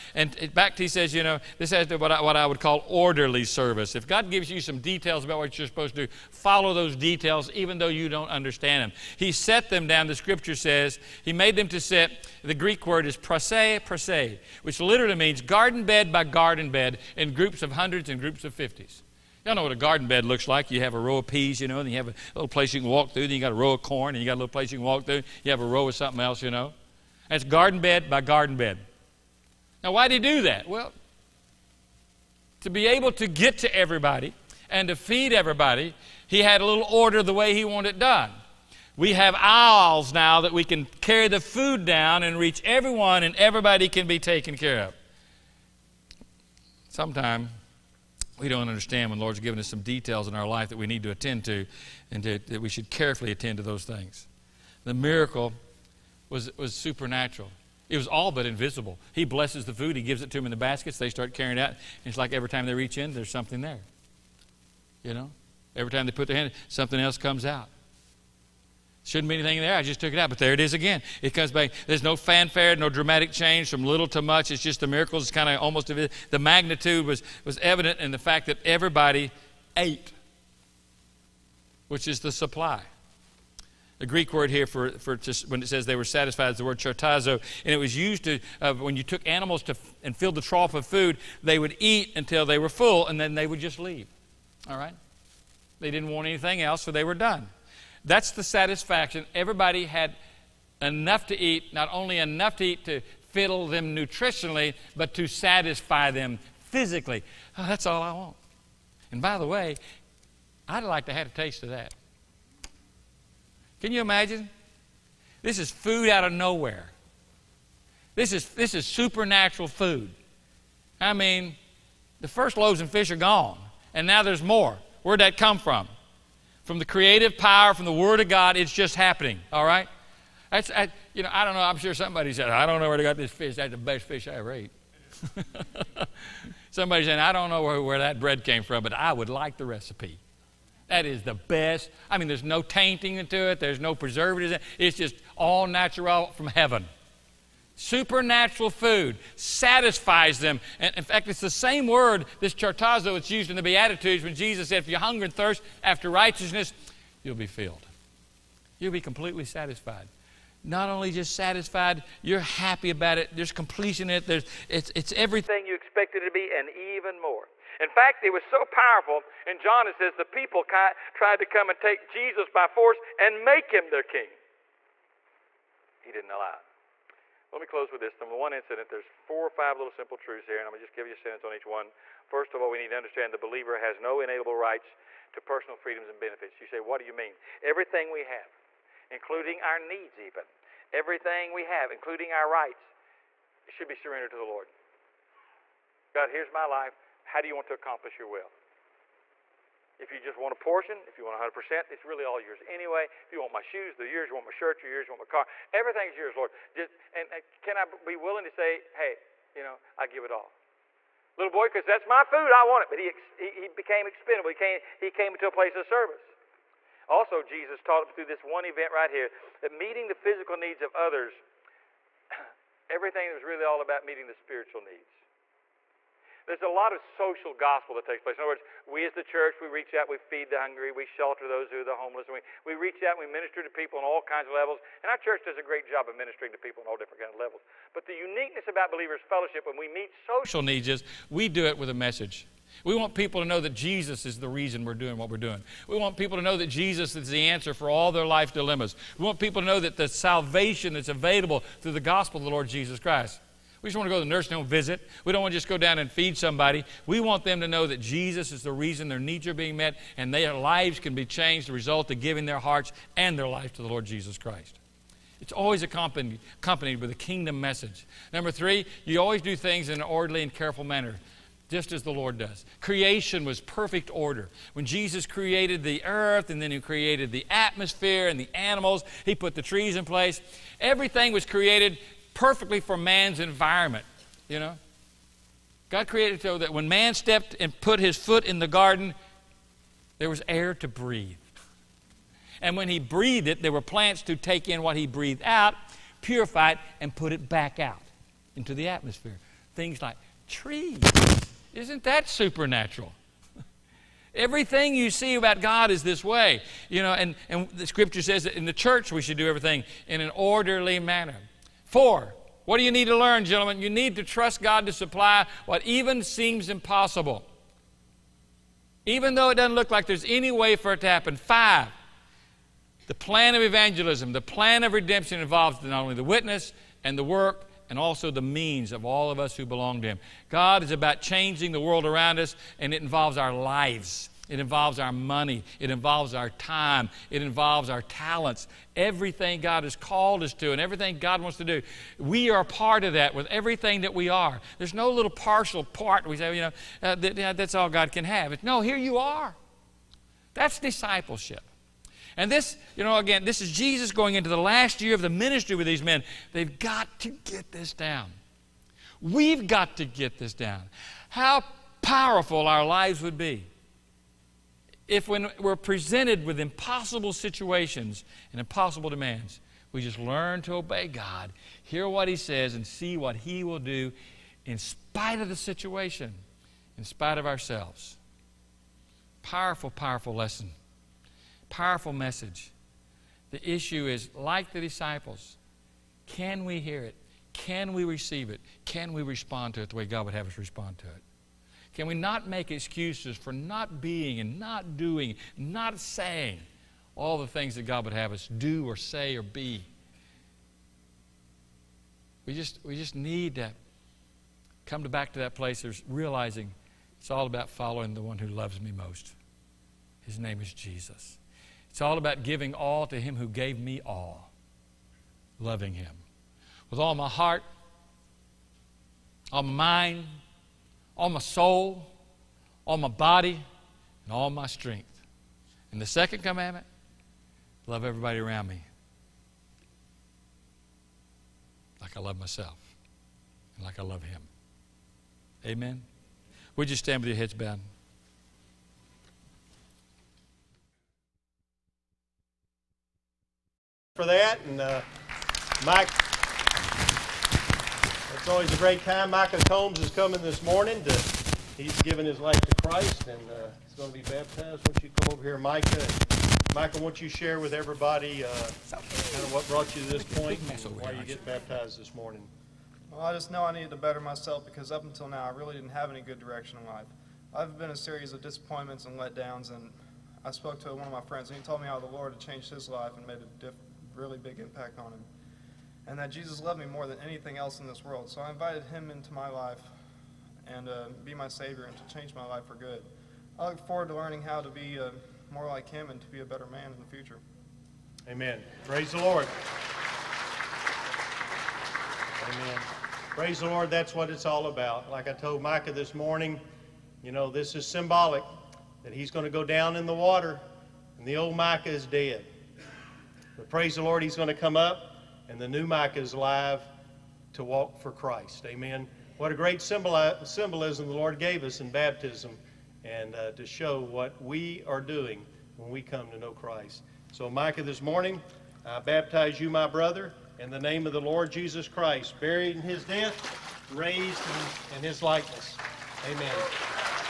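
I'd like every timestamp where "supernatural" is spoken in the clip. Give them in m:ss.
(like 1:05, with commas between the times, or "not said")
0:56, 1:58, 2:27, 5:02.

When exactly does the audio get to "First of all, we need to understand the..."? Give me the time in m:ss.
3:02.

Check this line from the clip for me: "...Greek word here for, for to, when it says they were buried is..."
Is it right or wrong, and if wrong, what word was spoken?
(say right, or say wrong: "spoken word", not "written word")
wrong: "satisfied", not "buried".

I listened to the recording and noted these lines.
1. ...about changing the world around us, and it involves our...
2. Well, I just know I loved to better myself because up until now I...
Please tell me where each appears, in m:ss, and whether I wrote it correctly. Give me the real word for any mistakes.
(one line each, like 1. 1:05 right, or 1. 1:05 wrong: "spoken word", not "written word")
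1. 5:30 right
2. 7:43 wrong: "needed", not "loved".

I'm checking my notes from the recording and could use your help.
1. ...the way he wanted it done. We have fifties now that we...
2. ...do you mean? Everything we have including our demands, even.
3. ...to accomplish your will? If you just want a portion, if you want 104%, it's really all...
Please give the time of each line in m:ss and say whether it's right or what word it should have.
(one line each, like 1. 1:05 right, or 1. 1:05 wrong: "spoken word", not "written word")
1. 0:37 wrong: "aisles", not "fifties"
2. 3:06 wrong: "needs", not "demands"
3. 3:17 wrong: "100", not "104".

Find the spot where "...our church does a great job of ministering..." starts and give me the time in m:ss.
3:55.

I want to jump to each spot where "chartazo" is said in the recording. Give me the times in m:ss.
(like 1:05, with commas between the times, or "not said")
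1:26, 2:32.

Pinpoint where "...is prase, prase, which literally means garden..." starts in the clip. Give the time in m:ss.
0:13.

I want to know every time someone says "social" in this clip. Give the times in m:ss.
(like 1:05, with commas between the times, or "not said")
3:47, 4:00.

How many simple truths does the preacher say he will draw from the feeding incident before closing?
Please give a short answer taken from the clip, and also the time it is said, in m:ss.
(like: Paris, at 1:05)
4 or 5, at 2:59.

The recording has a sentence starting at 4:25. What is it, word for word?
It's always accompanied, accompanied with a kingdom message.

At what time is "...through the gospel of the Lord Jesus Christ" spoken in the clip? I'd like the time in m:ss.
4:11.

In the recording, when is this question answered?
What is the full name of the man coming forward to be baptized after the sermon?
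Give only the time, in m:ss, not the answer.
7:29.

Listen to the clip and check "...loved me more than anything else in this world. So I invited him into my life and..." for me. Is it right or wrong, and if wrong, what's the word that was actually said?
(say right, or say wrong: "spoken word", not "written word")
right.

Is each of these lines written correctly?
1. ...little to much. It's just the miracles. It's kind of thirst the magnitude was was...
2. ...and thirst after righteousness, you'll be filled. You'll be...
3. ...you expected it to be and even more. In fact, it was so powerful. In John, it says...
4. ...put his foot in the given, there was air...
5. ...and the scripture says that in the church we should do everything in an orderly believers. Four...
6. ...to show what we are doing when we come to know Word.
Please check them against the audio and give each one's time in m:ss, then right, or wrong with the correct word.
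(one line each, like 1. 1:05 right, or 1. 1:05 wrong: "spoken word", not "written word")
1. 1:13 wrong: "almost", not "thirst"
2. 2:35 right
3. 2:45 right
4. 4:47 wrong: "garden", not "given"
5. 5:07 wrong: "manner", not "believers"
6. 8:33 wrong: "Christ", not "Word".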